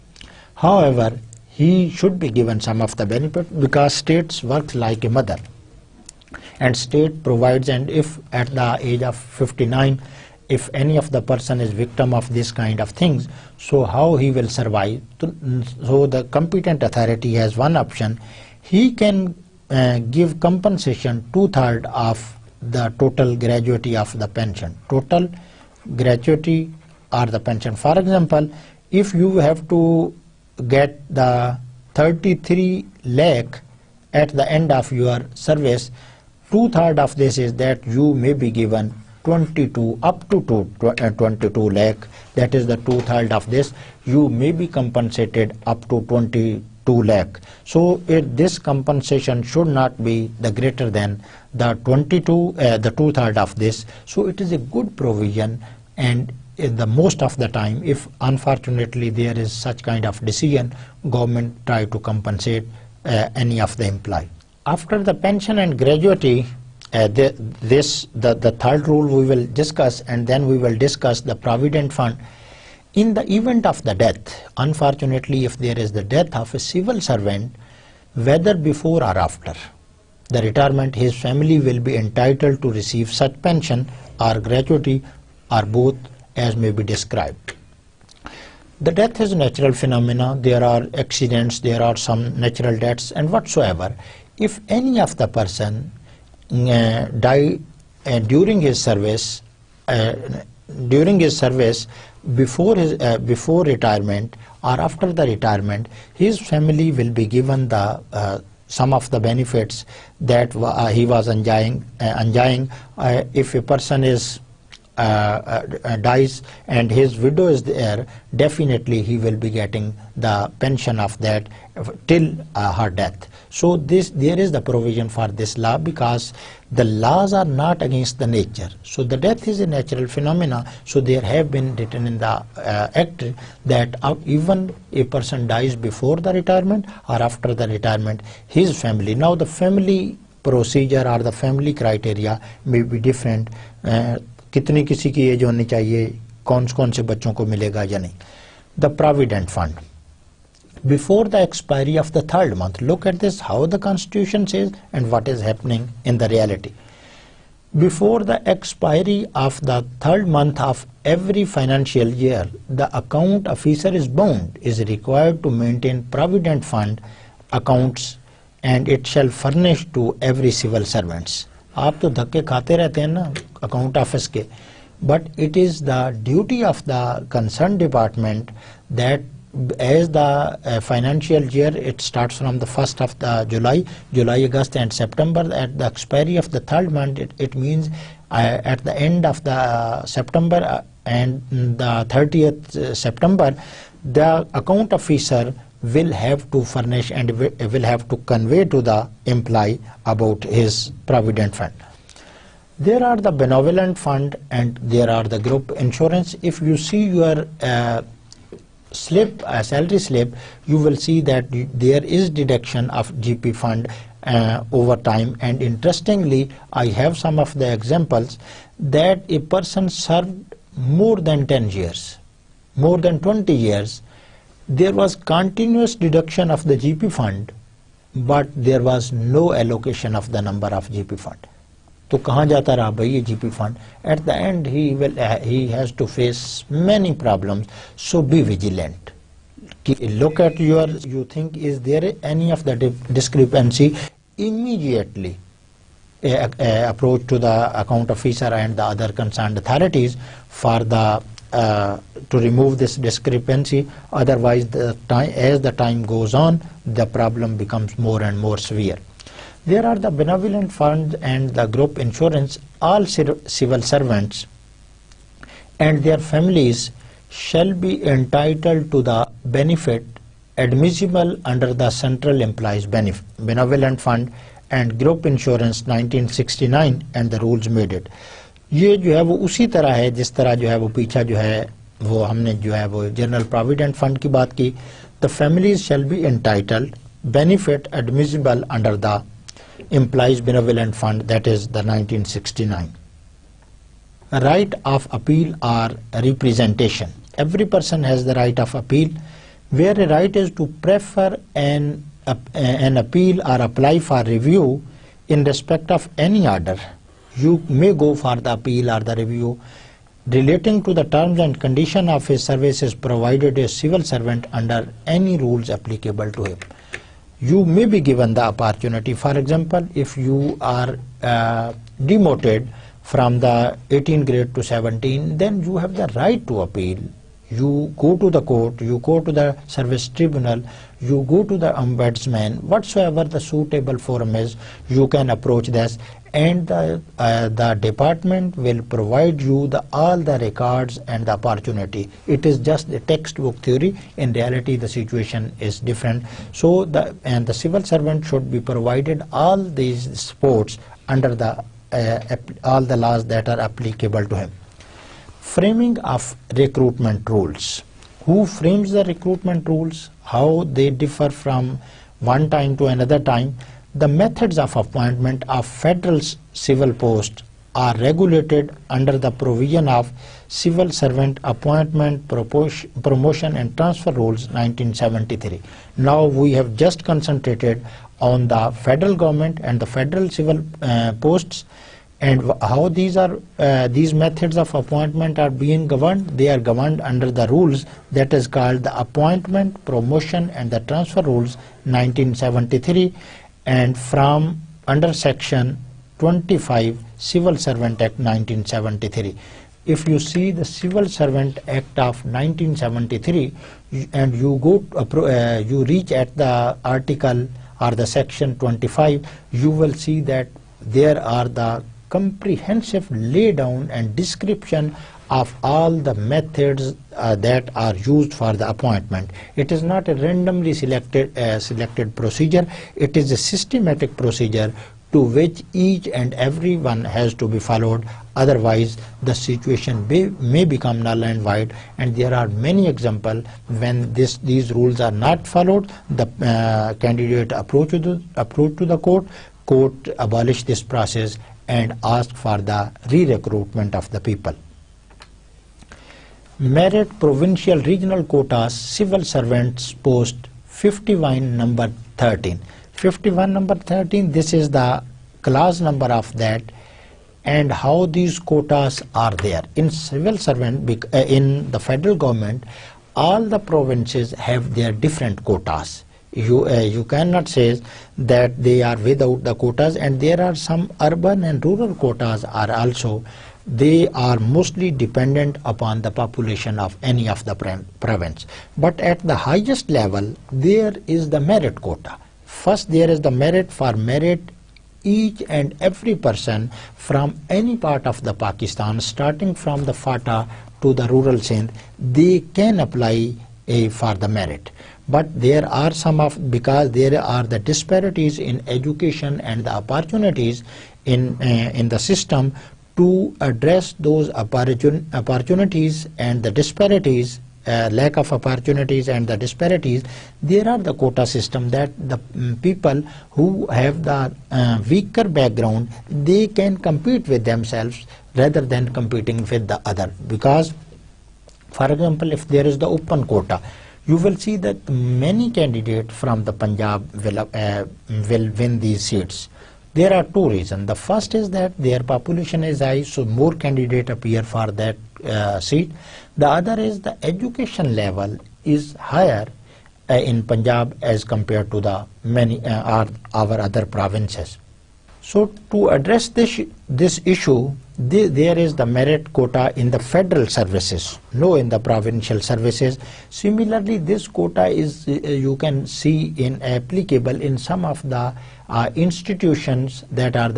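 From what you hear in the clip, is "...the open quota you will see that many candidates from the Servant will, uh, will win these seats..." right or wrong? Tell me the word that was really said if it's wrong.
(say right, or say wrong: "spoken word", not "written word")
wrong: "Punjab", not "Servant".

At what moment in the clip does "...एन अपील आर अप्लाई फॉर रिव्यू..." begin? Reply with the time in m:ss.
5:02.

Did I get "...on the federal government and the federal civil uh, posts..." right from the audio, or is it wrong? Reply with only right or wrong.
right.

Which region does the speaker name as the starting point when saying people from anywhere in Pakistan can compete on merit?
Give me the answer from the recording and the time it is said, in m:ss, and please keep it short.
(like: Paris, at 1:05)
FATA, at 8:09.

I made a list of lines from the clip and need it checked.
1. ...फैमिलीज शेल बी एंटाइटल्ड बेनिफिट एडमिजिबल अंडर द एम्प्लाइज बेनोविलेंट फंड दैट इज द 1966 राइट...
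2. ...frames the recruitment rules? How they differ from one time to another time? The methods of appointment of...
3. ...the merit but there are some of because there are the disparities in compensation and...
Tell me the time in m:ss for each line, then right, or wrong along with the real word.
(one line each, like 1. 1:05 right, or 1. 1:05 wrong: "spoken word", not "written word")
1. 4:45 wrong: "1969", not "1966"
2. 5:58 right
3. 8:14 wrong: "education", not "compensation".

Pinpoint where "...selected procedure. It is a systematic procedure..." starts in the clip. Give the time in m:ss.
7:01.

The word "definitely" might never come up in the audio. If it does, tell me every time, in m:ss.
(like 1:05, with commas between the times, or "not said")
1:58.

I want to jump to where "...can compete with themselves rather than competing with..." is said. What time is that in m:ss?
8:36.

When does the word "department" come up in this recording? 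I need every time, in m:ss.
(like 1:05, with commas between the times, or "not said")
2:57, 5:37.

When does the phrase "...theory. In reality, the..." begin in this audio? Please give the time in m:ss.
5:43.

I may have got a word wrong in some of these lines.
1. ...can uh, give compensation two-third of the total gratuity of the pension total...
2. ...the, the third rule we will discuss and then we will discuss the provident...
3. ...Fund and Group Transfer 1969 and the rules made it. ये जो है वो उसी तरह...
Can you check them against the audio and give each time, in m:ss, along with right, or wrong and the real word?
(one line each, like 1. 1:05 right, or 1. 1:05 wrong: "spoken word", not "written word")
1. 0:18 right
2. 1:08 right
3. 4:33 wrong: "Insurance", not "Transfer".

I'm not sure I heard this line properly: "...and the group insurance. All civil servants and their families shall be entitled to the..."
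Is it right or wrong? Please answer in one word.
right.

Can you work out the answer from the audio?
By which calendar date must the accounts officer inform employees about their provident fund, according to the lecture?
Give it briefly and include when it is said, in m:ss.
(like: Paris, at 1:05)
30th September, at 3:12.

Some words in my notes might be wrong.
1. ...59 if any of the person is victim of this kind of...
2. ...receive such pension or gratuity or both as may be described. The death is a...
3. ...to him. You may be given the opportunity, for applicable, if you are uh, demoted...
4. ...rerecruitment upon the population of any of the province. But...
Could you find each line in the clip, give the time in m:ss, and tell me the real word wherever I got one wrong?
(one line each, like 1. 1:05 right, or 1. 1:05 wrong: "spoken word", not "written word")
1. 0:09 right
2. 1:22 right
3. 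5:16 wrong: "example", not "applicable"
4. 7:54 wrong: "dependent", not "rerecruitment".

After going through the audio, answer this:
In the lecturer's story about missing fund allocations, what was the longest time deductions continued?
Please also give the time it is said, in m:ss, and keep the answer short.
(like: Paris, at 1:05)
20 years, at 3:42.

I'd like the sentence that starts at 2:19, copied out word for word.
Now the family procedure or the family criteria may be different.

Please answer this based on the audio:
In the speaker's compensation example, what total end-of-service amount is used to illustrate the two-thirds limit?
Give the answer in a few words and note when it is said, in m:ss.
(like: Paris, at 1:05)
33 lakh, at 0:31.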